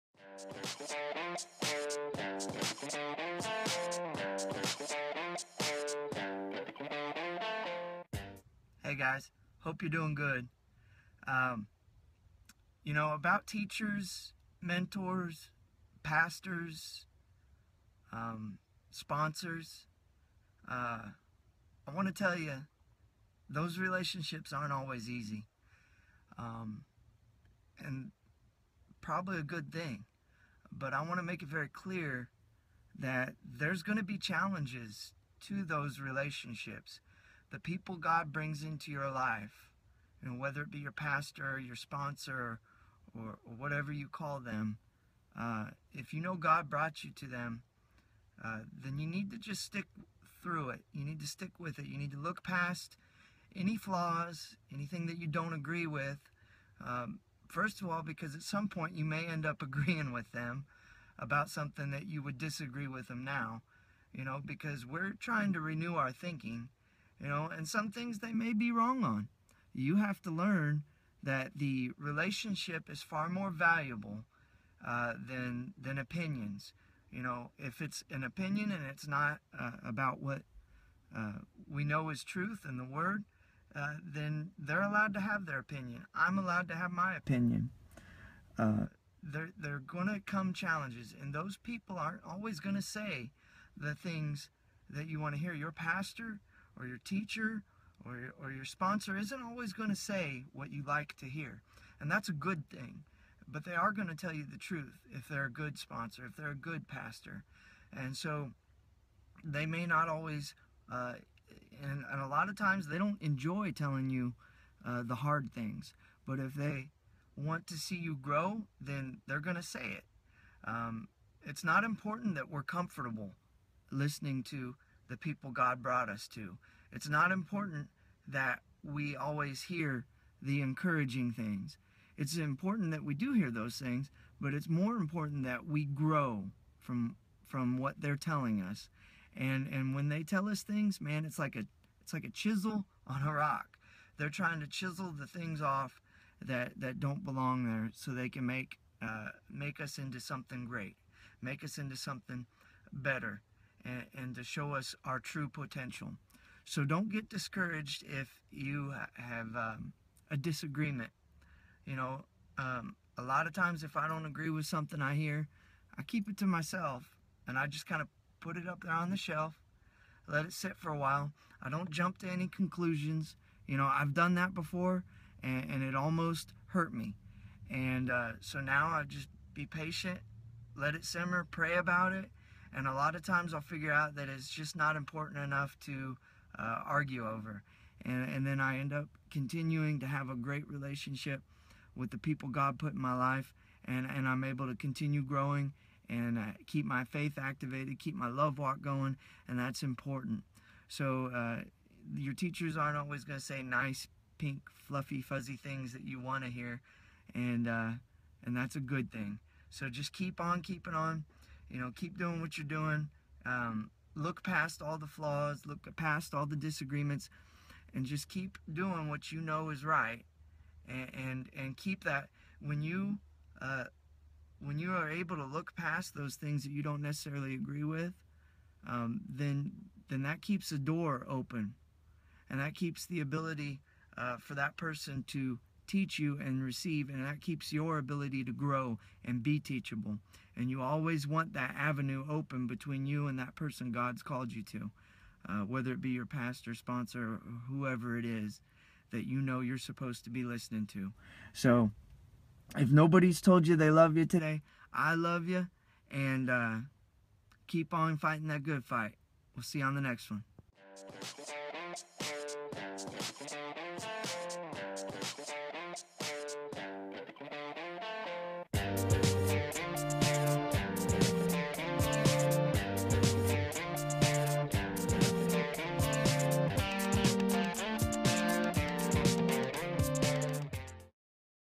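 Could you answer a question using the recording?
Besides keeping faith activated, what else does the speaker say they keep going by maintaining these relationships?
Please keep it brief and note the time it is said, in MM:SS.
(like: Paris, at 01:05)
love walk, at 03:18.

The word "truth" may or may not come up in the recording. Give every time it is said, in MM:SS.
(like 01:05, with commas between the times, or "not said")
01:22, 01:44.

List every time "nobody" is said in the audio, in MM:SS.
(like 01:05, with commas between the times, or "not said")
04:12.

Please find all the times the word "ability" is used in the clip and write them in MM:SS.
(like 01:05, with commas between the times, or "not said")
03:53, 03:57.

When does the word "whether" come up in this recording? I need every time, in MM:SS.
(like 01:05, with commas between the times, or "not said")
00:40, 04:05.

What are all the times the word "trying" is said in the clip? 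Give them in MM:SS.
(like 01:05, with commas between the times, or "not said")
01:05, 02:24.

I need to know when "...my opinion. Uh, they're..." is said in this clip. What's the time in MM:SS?
01:26.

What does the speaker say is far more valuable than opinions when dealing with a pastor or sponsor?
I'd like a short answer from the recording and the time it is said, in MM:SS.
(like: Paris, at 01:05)
the relationship, at 01:11.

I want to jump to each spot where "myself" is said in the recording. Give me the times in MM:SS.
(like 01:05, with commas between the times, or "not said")
02:46.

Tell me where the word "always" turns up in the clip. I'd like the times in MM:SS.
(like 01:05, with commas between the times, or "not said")
00:24, 01:32, 01:39, 01:50, 02:09, 03:22, 04:00.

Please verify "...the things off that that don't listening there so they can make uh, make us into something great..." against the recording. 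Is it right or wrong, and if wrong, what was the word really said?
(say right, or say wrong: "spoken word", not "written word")
wrong: "belong", not "listening".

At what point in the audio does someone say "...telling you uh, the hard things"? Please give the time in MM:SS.
01:53.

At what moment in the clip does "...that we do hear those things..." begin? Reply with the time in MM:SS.
02:12.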